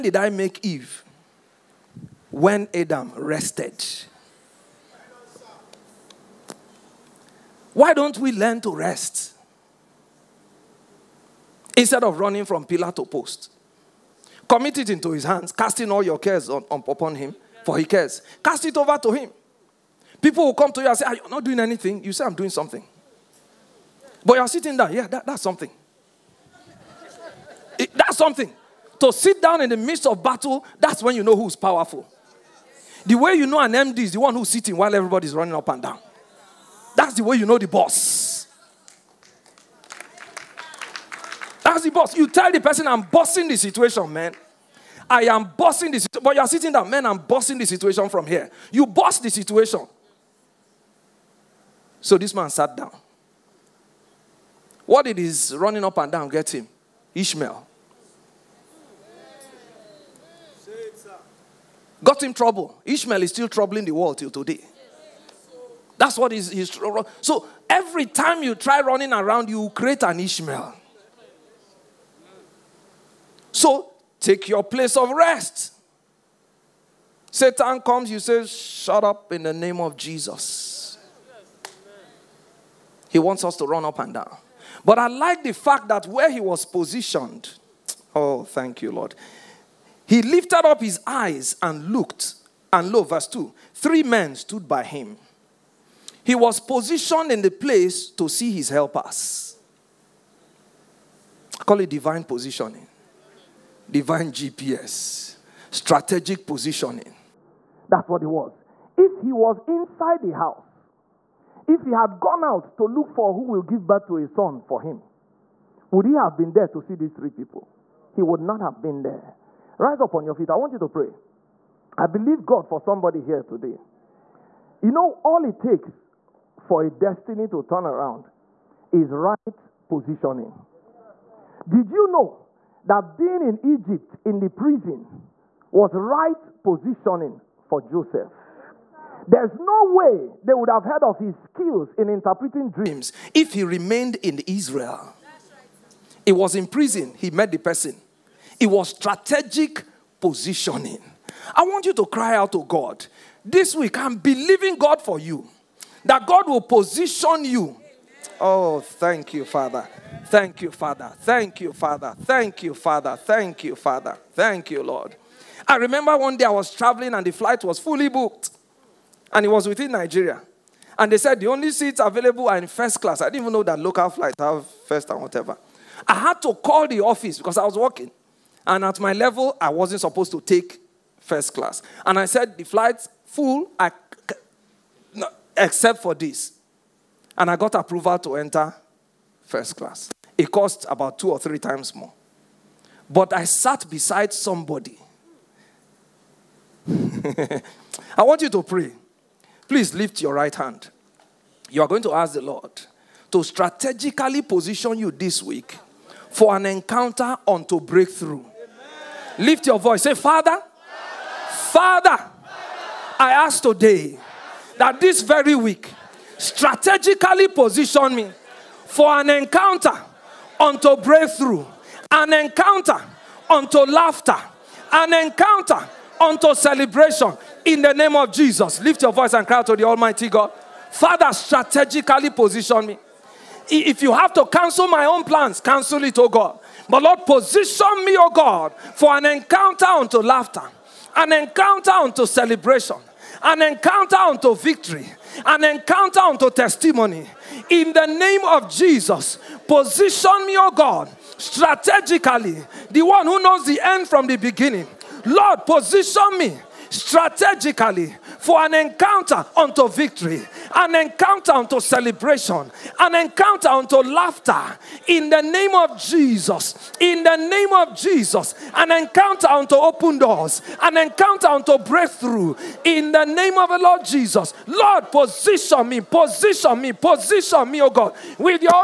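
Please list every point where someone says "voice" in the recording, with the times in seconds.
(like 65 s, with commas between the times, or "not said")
209 s, 229 s.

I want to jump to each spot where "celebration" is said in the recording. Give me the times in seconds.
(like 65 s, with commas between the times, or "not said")
226 s, 242 s, 261 s.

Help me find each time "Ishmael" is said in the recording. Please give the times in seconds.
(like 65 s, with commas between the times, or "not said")
57 s, 62 s, 70 s.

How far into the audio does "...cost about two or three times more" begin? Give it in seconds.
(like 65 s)
190 s.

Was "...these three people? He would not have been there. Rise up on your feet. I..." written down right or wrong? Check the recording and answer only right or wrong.
right.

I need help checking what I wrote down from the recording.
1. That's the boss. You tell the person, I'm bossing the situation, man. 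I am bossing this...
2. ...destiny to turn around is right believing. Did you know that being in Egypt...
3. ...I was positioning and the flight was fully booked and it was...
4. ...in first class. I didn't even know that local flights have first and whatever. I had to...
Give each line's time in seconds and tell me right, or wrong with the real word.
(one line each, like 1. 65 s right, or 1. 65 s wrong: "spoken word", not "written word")
1. 41 s right
2. 126 s wrong: "positioning", not "believing"
3. 166 s wrong: "traveling", not "positioning"
4. 172 s right.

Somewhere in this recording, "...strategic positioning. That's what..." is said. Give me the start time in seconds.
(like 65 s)
105 s.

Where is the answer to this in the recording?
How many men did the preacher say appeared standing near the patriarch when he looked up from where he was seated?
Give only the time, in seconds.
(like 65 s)
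93 s.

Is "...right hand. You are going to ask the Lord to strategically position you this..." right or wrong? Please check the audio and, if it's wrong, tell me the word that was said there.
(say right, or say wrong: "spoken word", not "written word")
right.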